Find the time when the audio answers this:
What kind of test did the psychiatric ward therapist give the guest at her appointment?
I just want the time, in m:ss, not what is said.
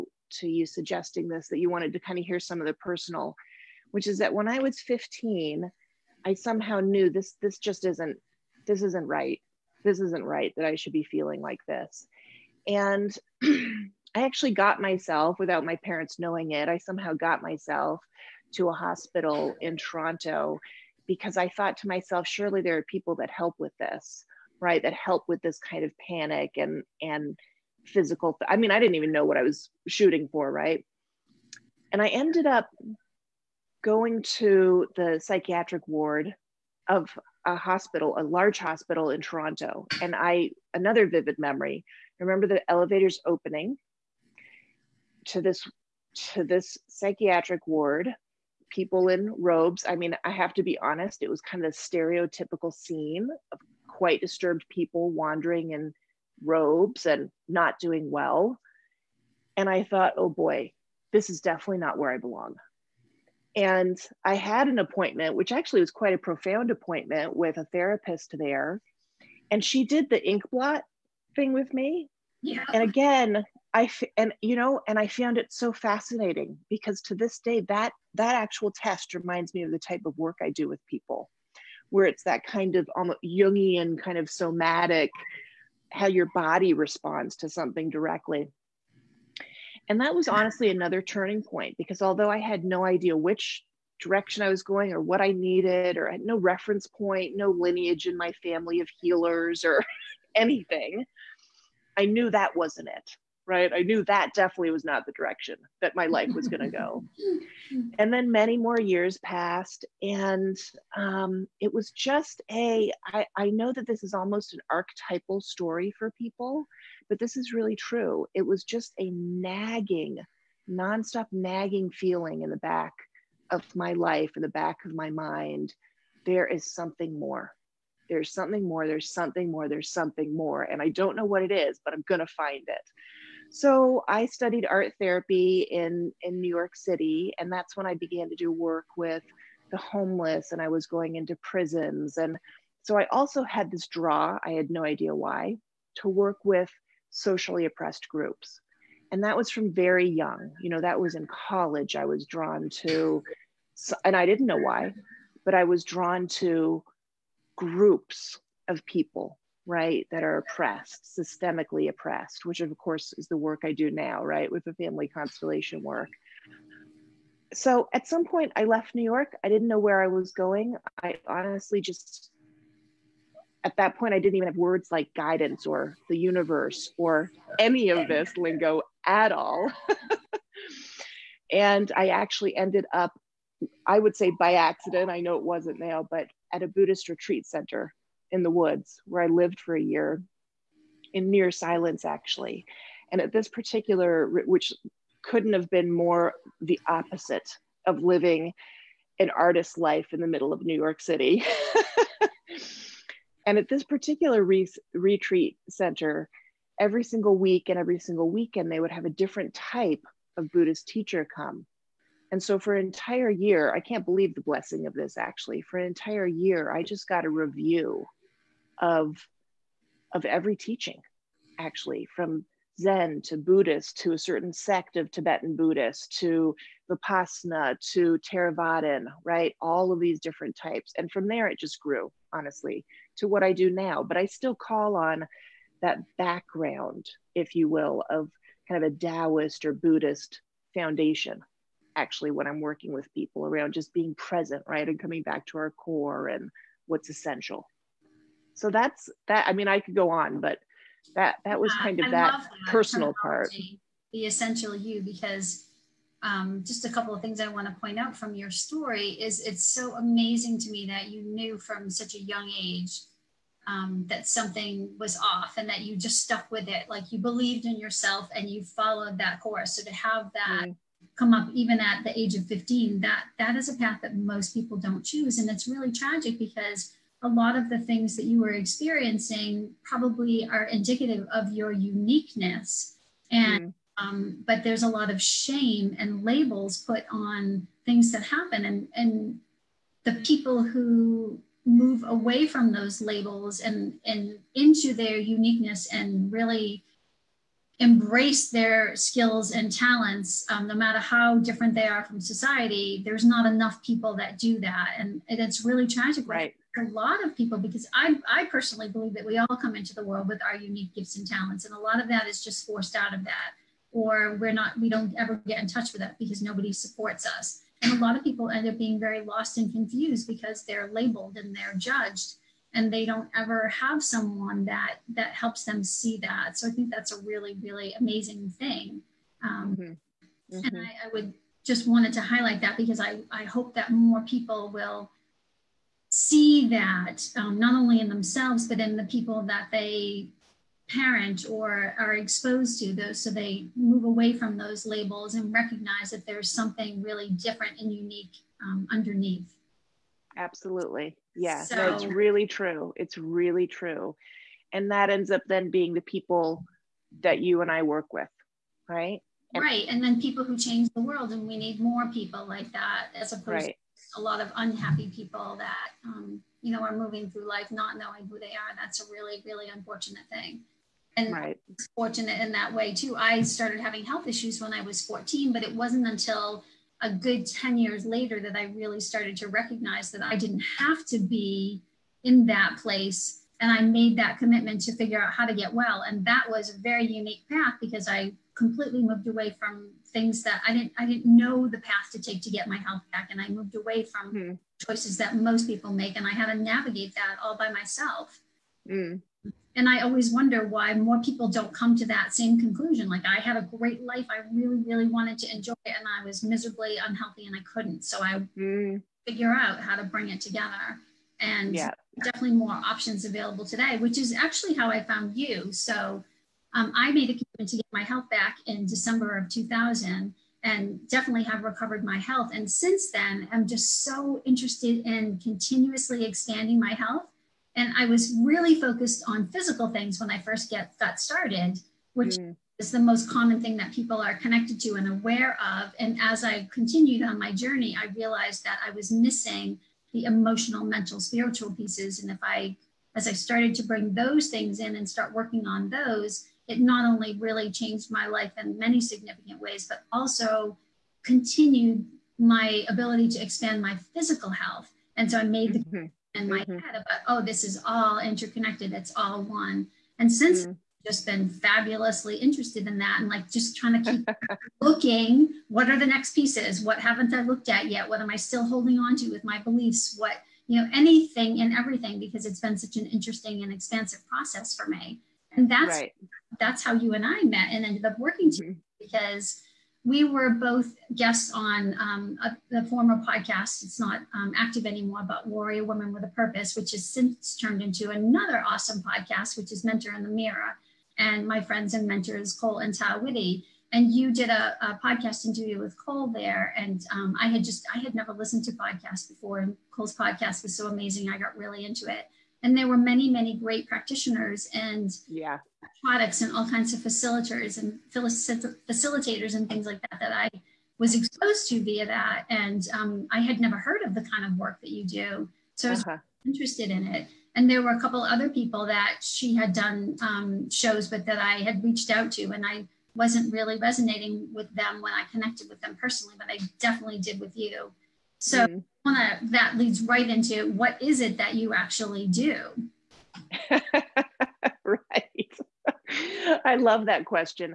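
1:10.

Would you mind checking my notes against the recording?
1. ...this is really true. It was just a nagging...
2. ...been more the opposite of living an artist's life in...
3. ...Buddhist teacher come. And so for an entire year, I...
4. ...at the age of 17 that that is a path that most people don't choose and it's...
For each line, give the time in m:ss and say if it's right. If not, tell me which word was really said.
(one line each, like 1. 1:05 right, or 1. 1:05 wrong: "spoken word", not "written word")
1. 1:57 right
2. 3:15 right
3. 3:30 right
4. 4:31 wrong: "15", not "17".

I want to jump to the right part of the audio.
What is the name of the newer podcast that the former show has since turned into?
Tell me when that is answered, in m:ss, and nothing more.
8:09.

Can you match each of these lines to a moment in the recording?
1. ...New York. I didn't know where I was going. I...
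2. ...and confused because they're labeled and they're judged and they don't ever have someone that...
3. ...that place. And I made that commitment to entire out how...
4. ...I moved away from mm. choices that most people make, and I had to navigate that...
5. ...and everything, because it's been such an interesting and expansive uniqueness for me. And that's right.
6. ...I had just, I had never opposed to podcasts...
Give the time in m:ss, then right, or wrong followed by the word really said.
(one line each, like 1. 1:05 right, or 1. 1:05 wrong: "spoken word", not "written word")
1. 2:48 right
2. 5:19 right
3. 6:22 wrong: "figure", not "entire"
4. 6:33 right
5. 7:51 wrong: "process", not "uniqueness"
6. 8:17 wrong: "listened", not "opposed".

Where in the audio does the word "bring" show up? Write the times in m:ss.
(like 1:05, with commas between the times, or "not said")
6:50, 7:23.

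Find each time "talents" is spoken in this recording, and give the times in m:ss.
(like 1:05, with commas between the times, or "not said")
4:59, 5:11.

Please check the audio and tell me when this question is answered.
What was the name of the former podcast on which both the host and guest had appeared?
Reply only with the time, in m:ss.
8:05.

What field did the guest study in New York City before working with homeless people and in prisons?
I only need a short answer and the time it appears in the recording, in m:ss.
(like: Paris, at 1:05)
Art therapy, at 2:14.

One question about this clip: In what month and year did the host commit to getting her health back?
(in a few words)
December 2000.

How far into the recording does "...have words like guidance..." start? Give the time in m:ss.
2:54.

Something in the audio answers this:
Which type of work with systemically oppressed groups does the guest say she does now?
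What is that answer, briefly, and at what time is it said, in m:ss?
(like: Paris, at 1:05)
Family constellation work, at 2:44.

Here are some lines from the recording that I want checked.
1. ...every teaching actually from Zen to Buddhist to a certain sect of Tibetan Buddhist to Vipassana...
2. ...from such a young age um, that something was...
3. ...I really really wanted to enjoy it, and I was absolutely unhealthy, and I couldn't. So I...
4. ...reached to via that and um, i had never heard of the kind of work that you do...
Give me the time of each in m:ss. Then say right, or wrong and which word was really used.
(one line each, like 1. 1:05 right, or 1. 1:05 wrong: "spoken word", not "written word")
1. 3:40 right
2. 4:21 right
3. 6:44 wrong: "miserably", not "absolutely"
4. 8:31 wrong: "exposed", not "reached".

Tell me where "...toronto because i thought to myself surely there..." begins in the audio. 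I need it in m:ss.
0:19.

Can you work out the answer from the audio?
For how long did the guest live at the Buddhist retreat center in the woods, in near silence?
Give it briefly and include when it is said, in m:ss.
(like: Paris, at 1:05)
A year, at 3:09.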